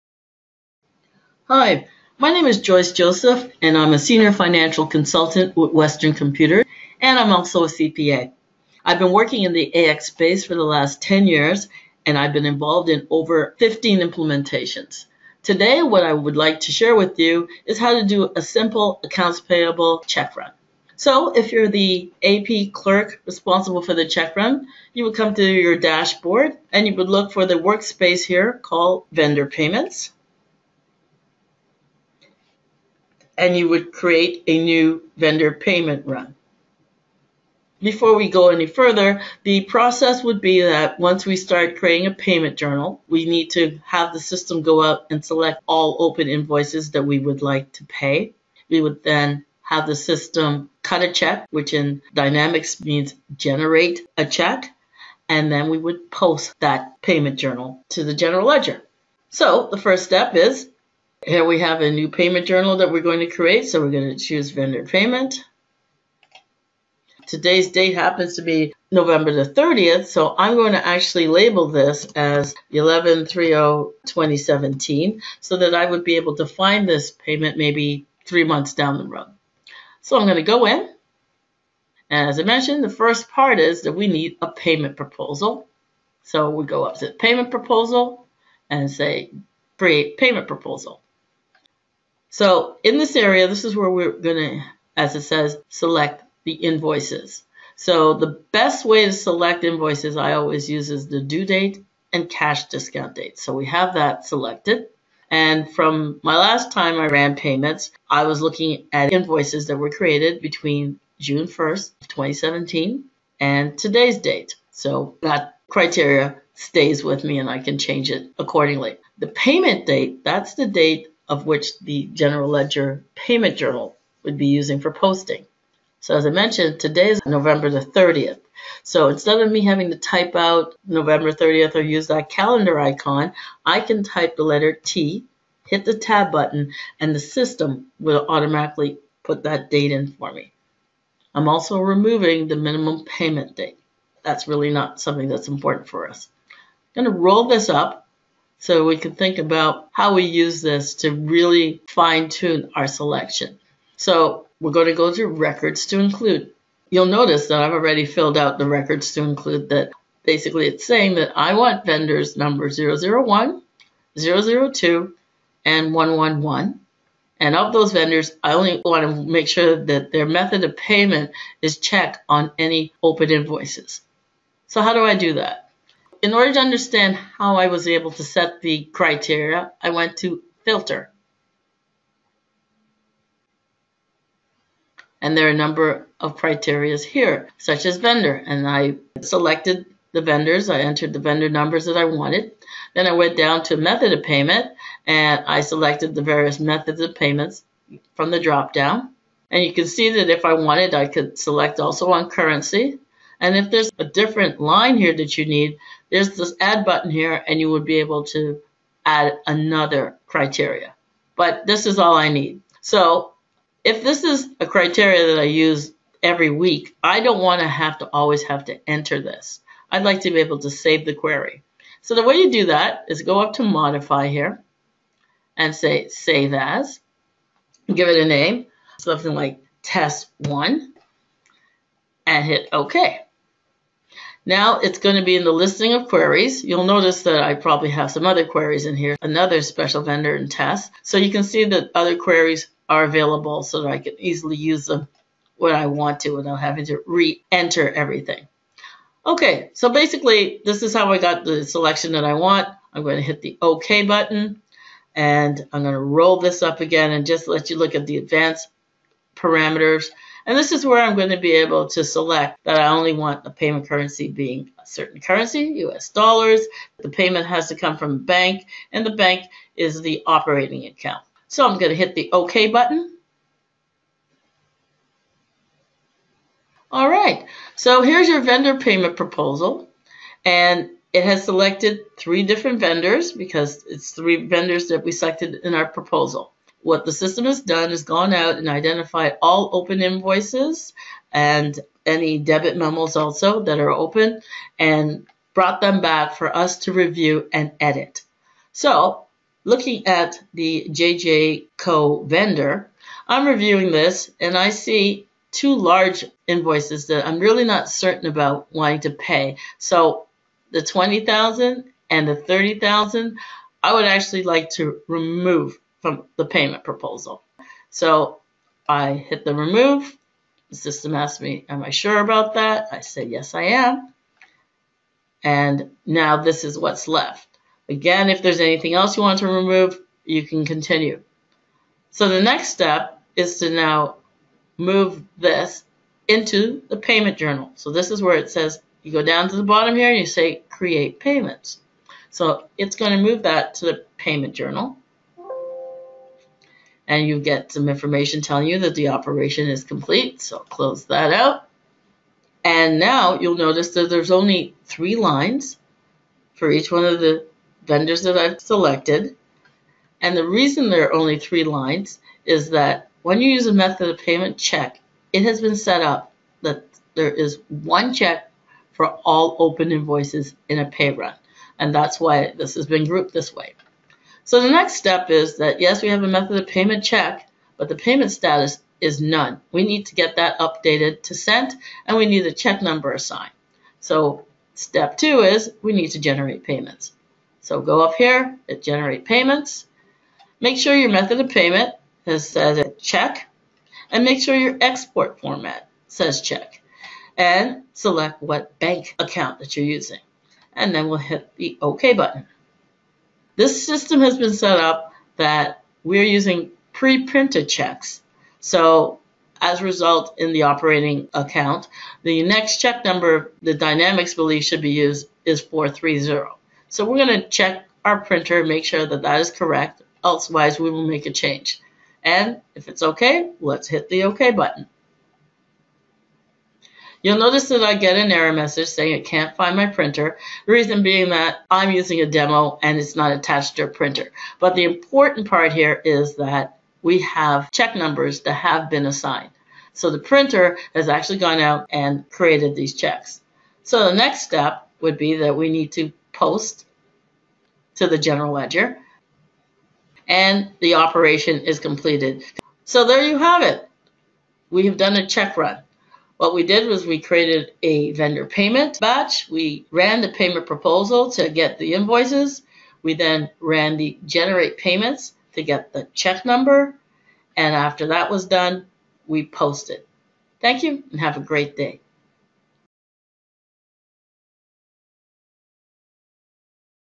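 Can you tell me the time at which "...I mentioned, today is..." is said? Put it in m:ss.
2:06.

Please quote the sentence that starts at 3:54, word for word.
Now it's going to be in the listing of queries.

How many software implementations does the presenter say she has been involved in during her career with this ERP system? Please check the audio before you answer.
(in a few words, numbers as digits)
over 15.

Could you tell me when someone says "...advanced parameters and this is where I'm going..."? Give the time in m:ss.
4:18.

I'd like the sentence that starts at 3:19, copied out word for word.
And you can see that if I wanted, I could select also on currency.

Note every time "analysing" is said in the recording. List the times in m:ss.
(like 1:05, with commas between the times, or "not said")
not said.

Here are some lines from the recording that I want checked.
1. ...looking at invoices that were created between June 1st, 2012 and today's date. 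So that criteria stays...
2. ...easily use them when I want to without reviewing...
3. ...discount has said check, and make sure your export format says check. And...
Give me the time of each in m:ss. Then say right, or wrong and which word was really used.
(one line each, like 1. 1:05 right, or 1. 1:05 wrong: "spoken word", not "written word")
1. 1:48 wrong: "2017", not "2012"
2. 4:04 wrong: "having", not "reviewing"
3. 6:31 wrong: "payment", not "discount".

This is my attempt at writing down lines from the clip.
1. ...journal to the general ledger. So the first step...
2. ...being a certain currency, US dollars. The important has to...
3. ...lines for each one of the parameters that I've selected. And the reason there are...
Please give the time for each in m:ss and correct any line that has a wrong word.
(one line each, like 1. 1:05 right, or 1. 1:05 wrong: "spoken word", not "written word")
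1. 0:57 right
2. 4:24 wrong: "payment", not "important"
3. 5:55 wrong: "vendors", not "parameters".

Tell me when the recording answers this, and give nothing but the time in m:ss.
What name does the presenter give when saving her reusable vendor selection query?
3:49.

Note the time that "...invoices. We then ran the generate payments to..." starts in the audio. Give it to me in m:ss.
7:41.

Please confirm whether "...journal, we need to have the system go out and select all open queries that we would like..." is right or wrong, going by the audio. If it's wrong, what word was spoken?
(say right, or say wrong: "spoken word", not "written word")
wrong: "invoices", not "queries".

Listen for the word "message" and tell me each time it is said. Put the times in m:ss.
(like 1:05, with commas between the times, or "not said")
7:08.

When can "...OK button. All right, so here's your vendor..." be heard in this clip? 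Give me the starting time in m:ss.
4:32.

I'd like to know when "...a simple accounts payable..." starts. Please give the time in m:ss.
0:18.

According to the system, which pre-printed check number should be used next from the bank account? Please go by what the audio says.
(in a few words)
430.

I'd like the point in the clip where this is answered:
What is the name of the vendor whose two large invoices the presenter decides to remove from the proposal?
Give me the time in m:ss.
5:00.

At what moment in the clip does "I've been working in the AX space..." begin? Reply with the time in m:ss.
0:08.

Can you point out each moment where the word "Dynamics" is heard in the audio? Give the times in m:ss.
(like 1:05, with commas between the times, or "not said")
0:52, 6:53.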